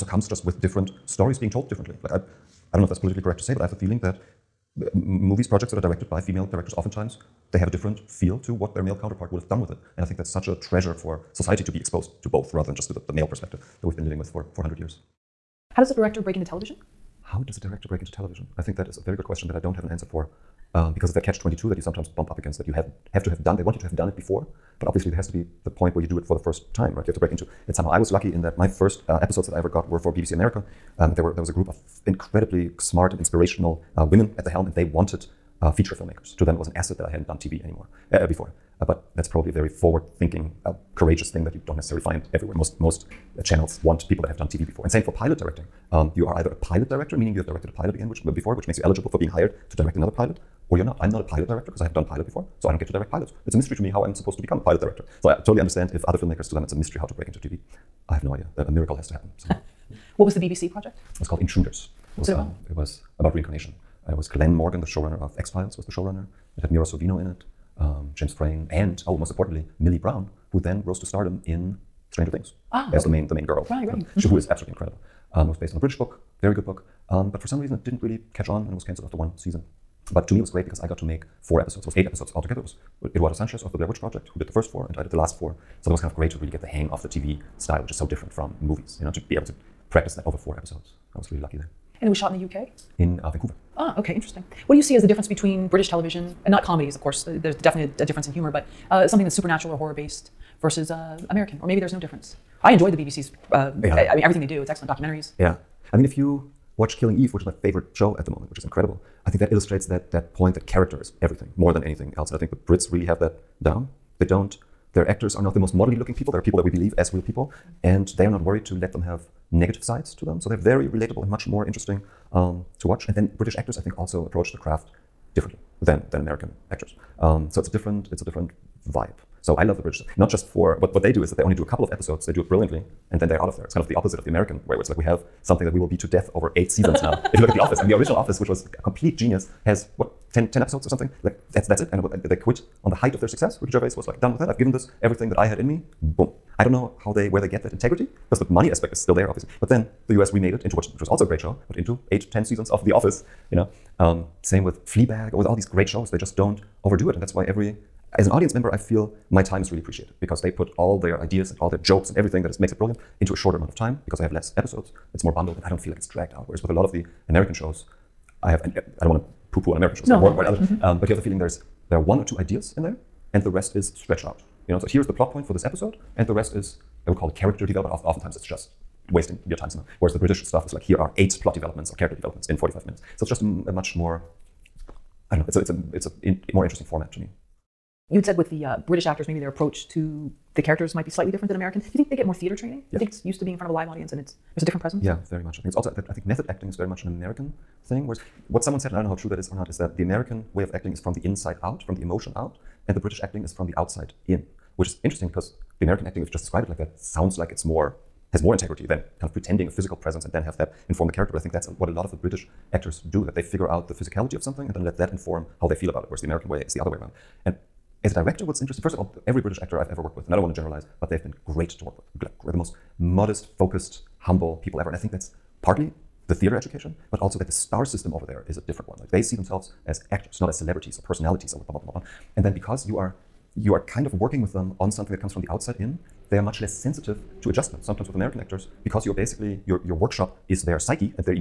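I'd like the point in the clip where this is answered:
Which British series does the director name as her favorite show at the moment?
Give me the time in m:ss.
1:46.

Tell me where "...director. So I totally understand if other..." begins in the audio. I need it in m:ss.
0:54.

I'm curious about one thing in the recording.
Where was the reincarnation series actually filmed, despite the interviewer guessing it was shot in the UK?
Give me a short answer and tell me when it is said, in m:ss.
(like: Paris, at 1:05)
Vancouver, at 1:33.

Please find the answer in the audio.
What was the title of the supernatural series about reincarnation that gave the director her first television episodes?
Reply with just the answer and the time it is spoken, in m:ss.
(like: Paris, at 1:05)
Intruders, at 1:01.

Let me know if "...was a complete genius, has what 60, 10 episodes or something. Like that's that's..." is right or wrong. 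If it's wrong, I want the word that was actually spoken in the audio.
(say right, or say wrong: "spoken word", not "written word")
wrong: "10", not "60".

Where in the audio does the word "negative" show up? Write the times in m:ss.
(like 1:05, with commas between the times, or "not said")
1:59.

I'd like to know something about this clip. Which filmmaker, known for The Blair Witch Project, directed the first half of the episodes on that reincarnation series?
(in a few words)
Eduardo Sanchez.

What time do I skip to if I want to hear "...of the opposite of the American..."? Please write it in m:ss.
2:13.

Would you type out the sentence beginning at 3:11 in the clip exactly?
Do you think they get more theater training?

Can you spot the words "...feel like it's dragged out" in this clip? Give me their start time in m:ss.
2:45.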